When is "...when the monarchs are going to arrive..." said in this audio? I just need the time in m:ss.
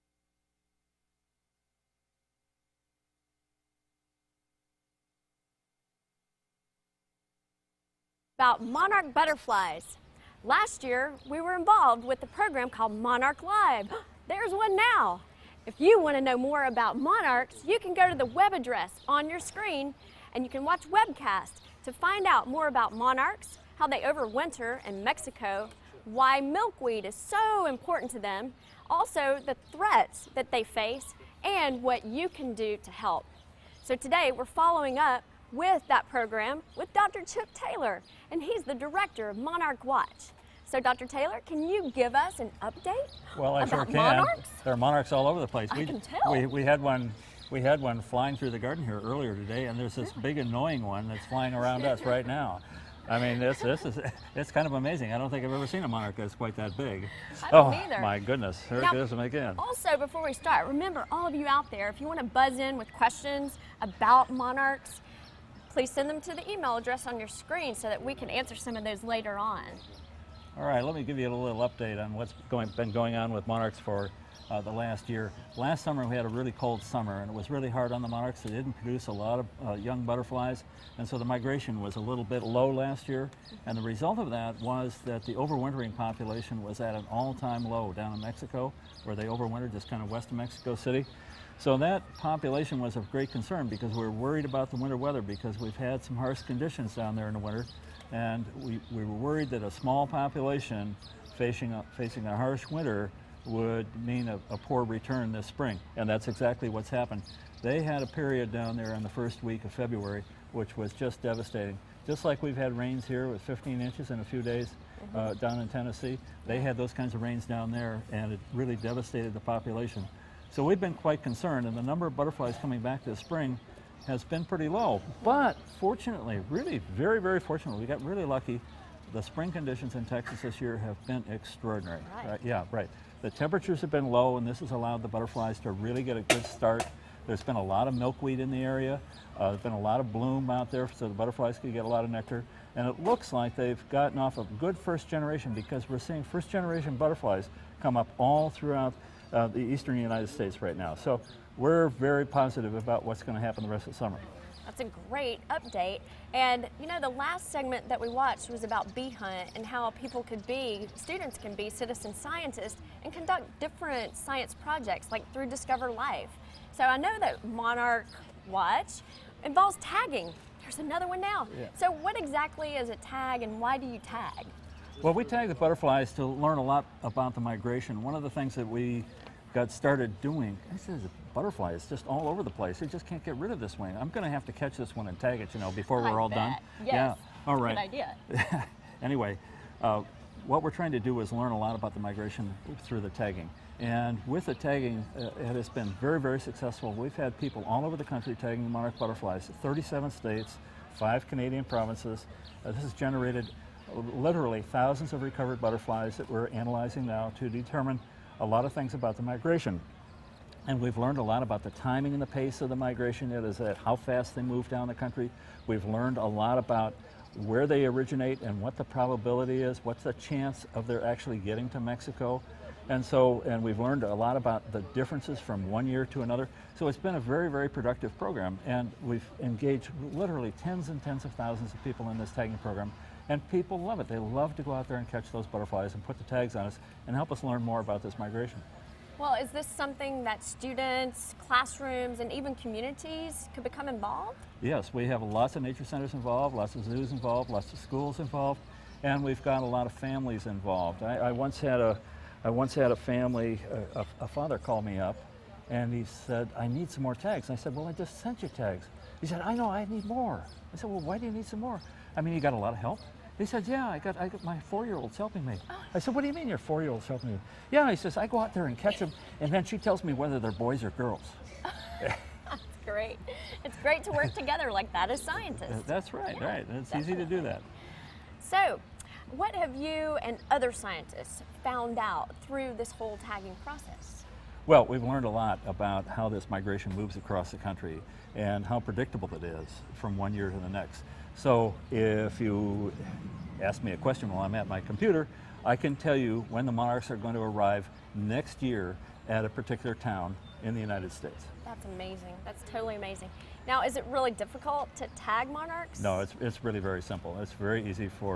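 4:56.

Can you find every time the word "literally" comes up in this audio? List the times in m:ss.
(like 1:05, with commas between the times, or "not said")
3:24, 3:50.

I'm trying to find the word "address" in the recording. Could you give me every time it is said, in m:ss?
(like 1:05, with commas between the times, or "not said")
0:18, 1:06.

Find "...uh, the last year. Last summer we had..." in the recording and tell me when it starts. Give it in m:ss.
1:14.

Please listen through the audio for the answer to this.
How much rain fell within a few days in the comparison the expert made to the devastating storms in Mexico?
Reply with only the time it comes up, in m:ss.
1:53.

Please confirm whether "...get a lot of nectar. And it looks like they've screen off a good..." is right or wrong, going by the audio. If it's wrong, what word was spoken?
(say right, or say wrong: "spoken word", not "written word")
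wrong: "gotten", not "screen".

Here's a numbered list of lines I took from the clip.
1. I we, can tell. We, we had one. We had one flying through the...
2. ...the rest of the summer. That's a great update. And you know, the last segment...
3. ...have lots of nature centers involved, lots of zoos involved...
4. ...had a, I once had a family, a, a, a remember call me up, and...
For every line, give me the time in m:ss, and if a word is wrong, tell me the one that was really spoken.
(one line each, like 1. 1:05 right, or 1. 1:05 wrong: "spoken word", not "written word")
1. 0:45 right
2. 2:33 right
3. 4:05 right
4. 4:11 wrong: "father", not "remember".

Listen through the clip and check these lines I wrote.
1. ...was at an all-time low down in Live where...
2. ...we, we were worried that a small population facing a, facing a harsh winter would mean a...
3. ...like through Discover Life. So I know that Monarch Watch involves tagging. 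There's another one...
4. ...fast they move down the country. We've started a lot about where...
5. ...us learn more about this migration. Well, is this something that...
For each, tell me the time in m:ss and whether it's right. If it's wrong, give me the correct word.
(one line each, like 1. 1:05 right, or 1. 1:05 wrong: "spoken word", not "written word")
1. 1:26 wrong: "Mexico", not "Live"
2. 1:38 right
3. 2:45 right
4. 3:33 wrong: "learned", not "started"
5. 3:57 right.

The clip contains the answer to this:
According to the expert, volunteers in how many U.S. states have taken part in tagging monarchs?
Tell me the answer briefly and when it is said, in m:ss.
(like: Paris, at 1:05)
37, at 3:19.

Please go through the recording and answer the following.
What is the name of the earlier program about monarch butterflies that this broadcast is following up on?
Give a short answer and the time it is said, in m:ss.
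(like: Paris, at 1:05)
Monarch Live, at 0:12.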